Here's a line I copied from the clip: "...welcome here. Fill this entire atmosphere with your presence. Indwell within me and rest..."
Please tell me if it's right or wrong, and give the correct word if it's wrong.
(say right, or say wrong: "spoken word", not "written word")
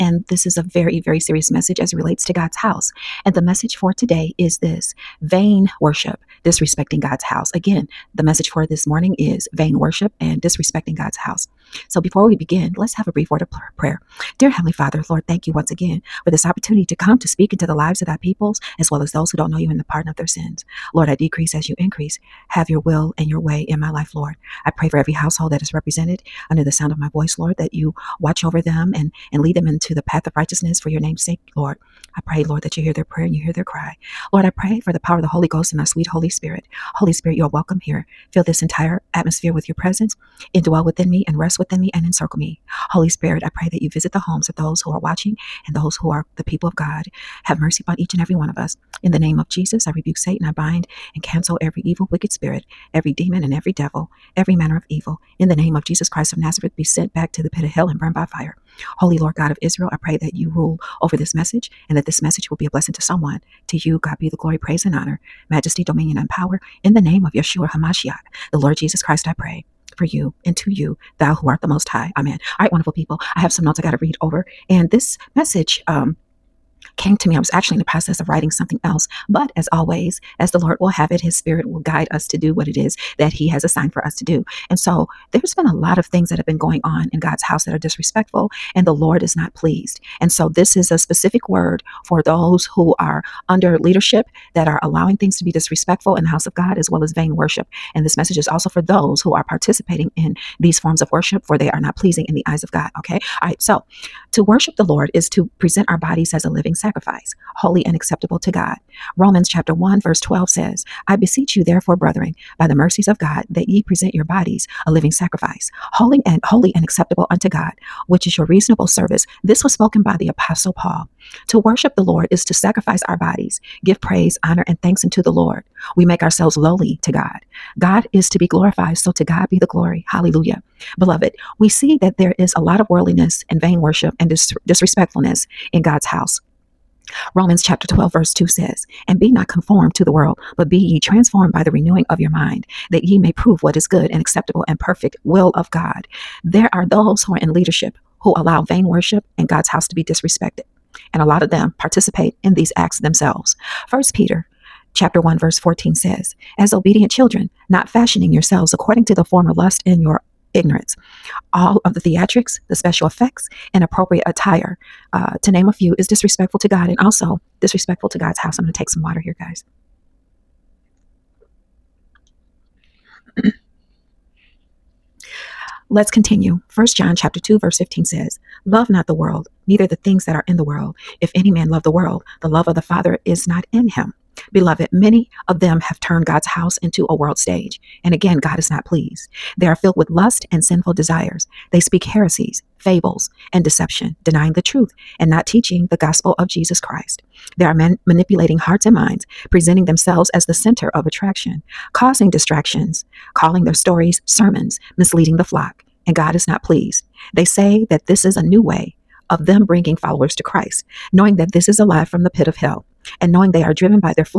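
right.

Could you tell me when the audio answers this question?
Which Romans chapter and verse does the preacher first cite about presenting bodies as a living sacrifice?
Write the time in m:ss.
1:49.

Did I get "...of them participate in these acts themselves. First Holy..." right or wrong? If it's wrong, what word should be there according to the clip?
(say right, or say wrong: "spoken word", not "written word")
wrong: "Peter", not "Holy".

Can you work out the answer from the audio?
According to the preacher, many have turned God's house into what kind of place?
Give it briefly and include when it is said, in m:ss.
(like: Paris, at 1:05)
a world stage, at 3:07.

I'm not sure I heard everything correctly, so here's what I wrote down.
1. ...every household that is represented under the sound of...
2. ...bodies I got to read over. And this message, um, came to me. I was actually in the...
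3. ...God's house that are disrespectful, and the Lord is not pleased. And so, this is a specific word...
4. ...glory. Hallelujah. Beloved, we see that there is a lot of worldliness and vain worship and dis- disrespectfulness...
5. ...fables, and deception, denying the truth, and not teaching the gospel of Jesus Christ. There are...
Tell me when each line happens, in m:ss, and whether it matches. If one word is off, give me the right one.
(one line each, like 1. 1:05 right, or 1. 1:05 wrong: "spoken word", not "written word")
1. 0:24 right
2. 1:13 wrong: "notes", not "bodies"
3. 1:27 right
4. 2:09 right
5. 3:12 right.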